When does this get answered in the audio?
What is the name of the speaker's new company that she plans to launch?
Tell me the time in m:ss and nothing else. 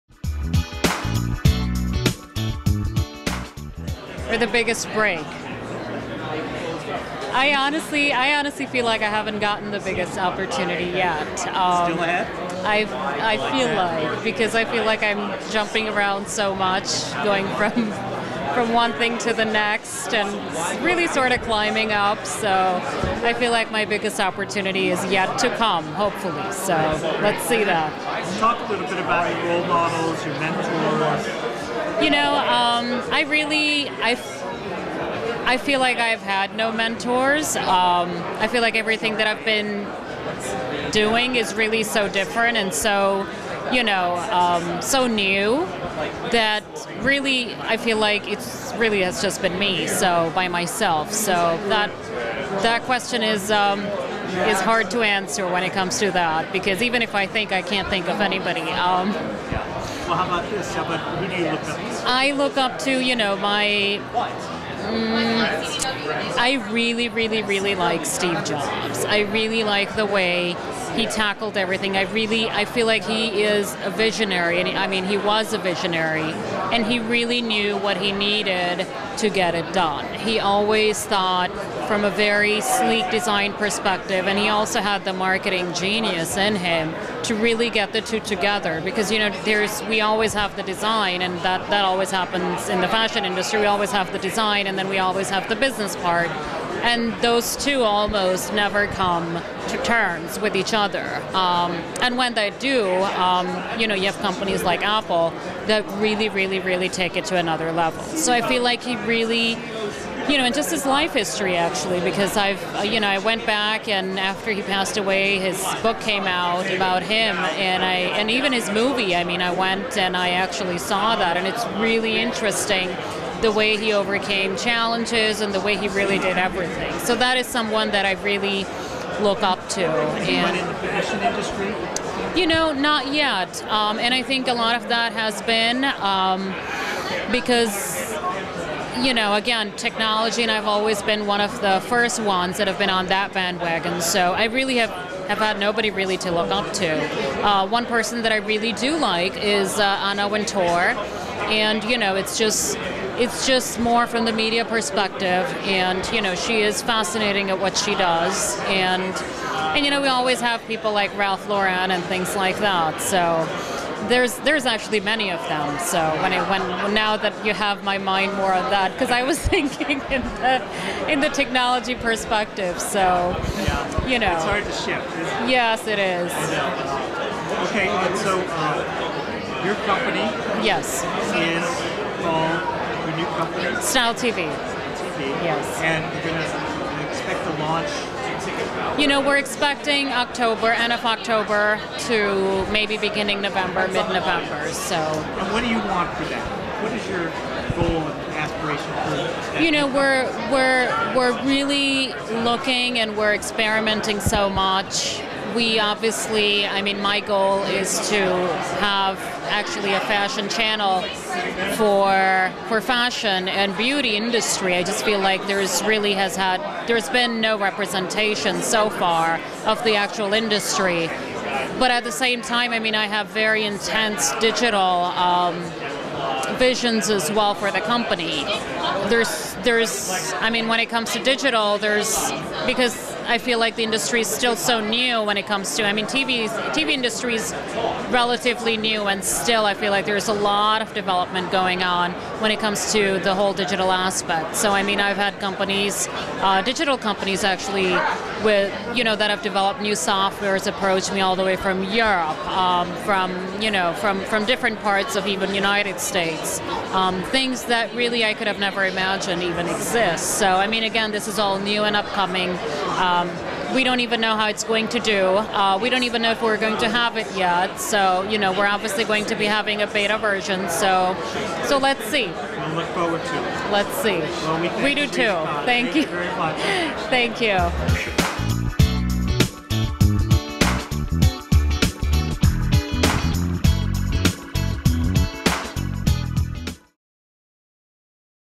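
3:03.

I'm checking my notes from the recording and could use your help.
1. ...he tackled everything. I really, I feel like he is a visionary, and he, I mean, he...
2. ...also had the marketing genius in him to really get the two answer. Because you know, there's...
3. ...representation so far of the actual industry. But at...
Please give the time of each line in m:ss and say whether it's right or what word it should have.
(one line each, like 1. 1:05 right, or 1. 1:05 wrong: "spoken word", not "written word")
1. 1:10 right
2. 1:24 wrong: "together", not "answer"
3. 3:37 right.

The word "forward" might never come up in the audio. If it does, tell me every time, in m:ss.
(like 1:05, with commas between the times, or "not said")
4:32.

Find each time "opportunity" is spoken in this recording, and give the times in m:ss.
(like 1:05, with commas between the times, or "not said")
0:10, 0:24.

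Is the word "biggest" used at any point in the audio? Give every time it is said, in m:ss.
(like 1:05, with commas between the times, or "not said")
0:04, 0:09, 0:23.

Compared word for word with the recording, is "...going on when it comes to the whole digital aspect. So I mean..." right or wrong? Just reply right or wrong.
right.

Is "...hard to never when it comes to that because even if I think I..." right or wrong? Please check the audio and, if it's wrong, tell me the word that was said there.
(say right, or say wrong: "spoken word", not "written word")
wrong: "answer", not "never".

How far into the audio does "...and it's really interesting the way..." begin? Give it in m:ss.
2:01.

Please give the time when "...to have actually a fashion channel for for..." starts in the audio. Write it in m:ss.
3:28.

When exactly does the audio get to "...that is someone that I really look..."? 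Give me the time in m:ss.
2:07.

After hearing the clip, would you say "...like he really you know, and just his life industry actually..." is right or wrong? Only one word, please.
wrong.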